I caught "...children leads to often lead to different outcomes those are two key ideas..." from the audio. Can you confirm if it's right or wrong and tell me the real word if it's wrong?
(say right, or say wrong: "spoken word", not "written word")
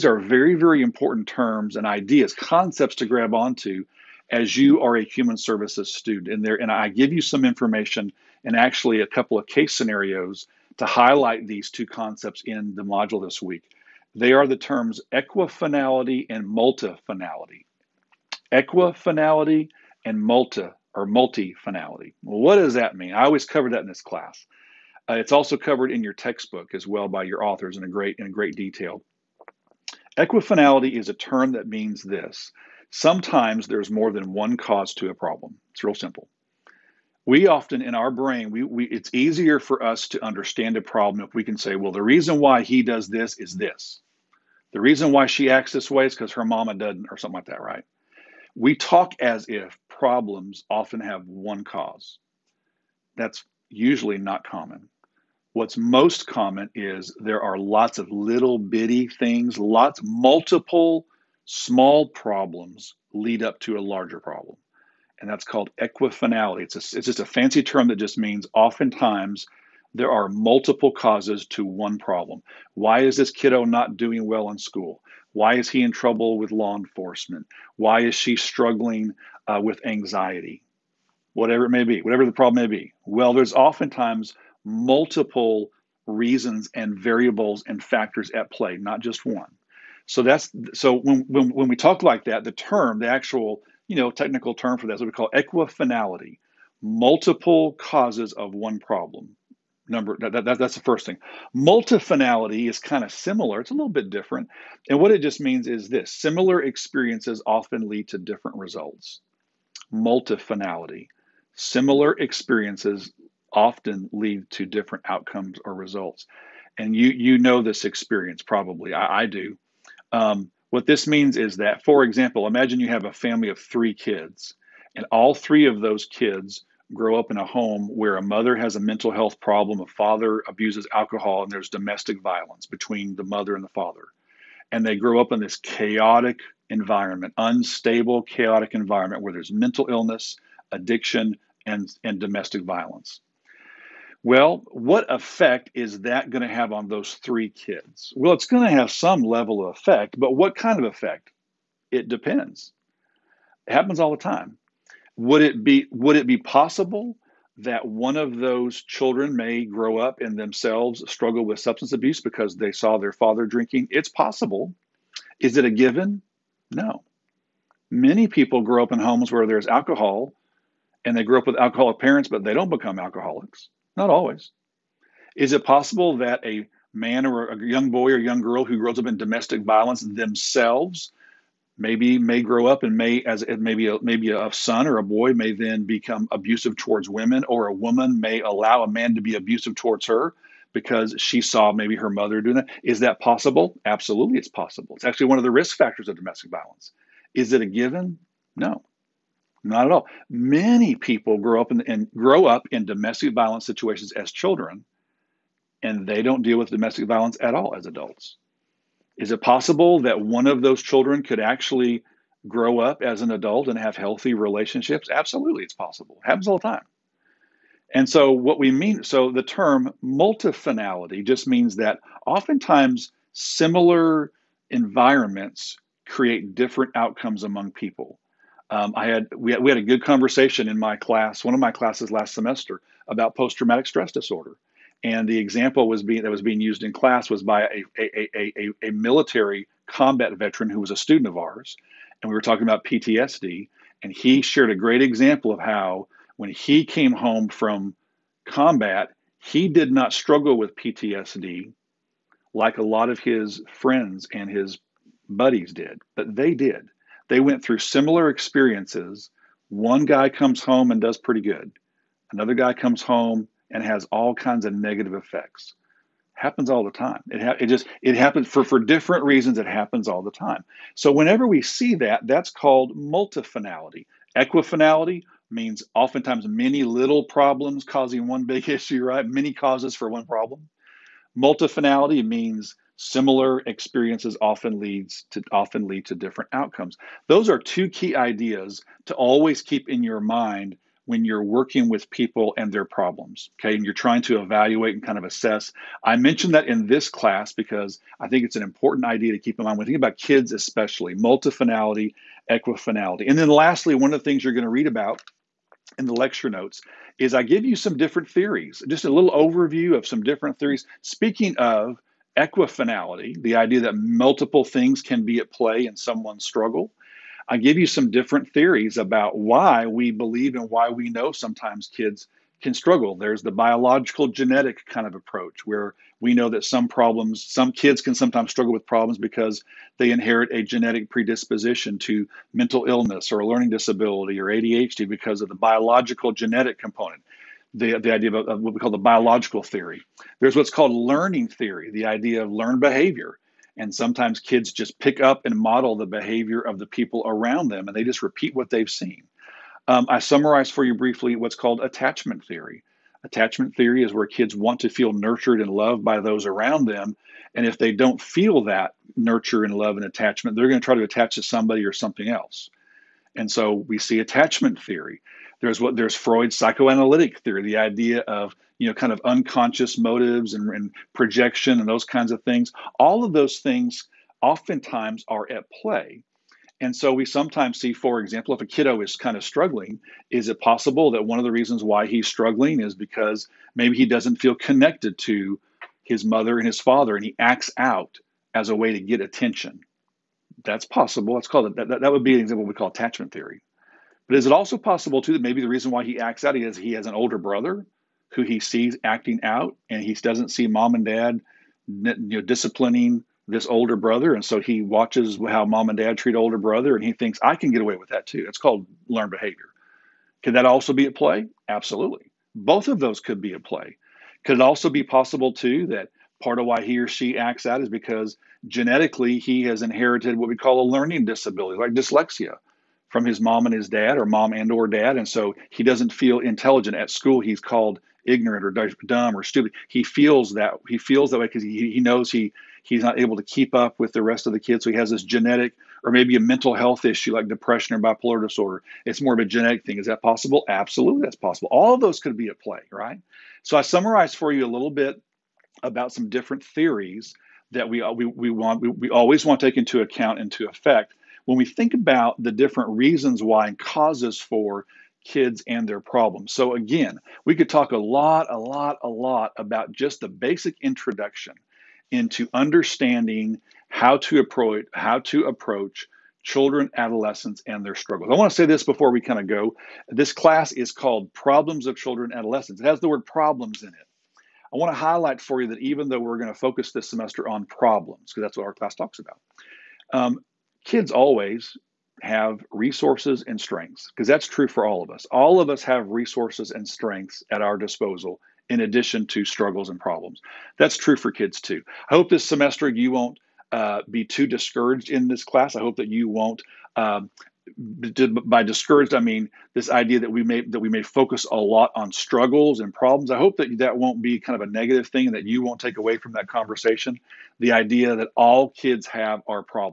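wrong: "often", not "children".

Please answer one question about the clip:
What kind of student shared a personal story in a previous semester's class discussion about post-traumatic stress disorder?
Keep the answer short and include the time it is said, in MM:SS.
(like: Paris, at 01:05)
Military combat veteran, at 03:58.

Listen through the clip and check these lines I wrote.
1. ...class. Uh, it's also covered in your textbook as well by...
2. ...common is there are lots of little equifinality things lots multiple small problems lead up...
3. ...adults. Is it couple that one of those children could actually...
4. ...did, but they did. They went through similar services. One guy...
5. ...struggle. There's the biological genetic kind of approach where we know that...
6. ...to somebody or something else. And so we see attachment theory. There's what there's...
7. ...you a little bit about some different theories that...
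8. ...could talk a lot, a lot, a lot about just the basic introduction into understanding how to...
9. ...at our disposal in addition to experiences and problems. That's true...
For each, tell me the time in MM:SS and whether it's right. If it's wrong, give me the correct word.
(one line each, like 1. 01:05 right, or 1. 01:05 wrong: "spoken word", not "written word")
1. 00:24 right
2. 00:56 wrong: "bitty", not "equifinality"
3. 03:27 wrong: "possible", not "couple"
4. 04:15 wrong: "experiences", not "services"
5. 05:22 right
6. 06:01 right
7. 07:24 right
8. 07:37 right
9. 08:07 wrong: "struggles", not "experiences".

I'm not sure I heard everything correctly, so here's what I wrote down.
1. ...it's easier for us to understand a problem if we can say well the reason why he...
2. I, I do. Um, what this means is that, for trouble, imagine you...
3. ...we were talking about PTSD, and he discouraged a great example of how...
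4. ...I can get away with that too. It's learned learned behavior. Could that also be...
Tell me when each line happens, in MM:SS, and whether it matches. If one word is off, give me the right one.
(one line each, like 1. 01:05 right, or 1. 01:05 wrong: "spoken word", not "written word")
1. 00:38 right
2. 01:58 wrong: "example", not "trouble"
3. 04:02 wrong: "shared", not "discouraged"
4. 06:47 wrong: "called", not "learned".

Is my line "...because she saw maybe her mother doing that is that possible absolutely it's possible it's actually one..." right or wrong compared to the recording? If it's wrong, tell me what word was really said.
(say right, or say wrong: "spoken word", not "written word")
right.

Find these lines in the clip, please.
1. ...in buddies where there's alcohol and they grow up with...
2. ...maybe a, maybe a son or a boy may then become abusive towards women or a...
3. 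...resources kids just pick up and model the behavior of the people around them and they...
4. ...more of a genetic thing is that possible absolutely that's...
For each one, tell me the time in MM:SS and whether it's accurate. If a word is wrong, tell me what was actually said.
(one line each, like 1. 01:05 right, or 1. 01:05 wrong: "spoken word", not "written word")
1. 02:48 wrong: "homes", not "buddies"
2. 03:03 right
3. 05:43 wrong: "sometimes", not "resources"
4. 07:19 right.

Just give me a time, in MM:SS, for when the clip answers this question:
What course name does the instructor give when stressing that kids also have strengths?
07:51.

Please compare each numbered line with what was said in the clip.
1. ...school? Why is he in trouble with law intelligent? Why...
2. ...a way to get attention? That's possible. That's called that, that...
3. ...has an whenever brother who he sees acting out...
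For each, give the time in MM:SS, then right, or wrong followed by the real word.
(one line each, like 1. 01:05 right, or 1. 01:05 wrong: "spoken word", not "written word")
1. 01:14 wrong: "enforcement", not "intelligent"
2. 06:28 right
3. 06:36 wrong: "older", not "whenever".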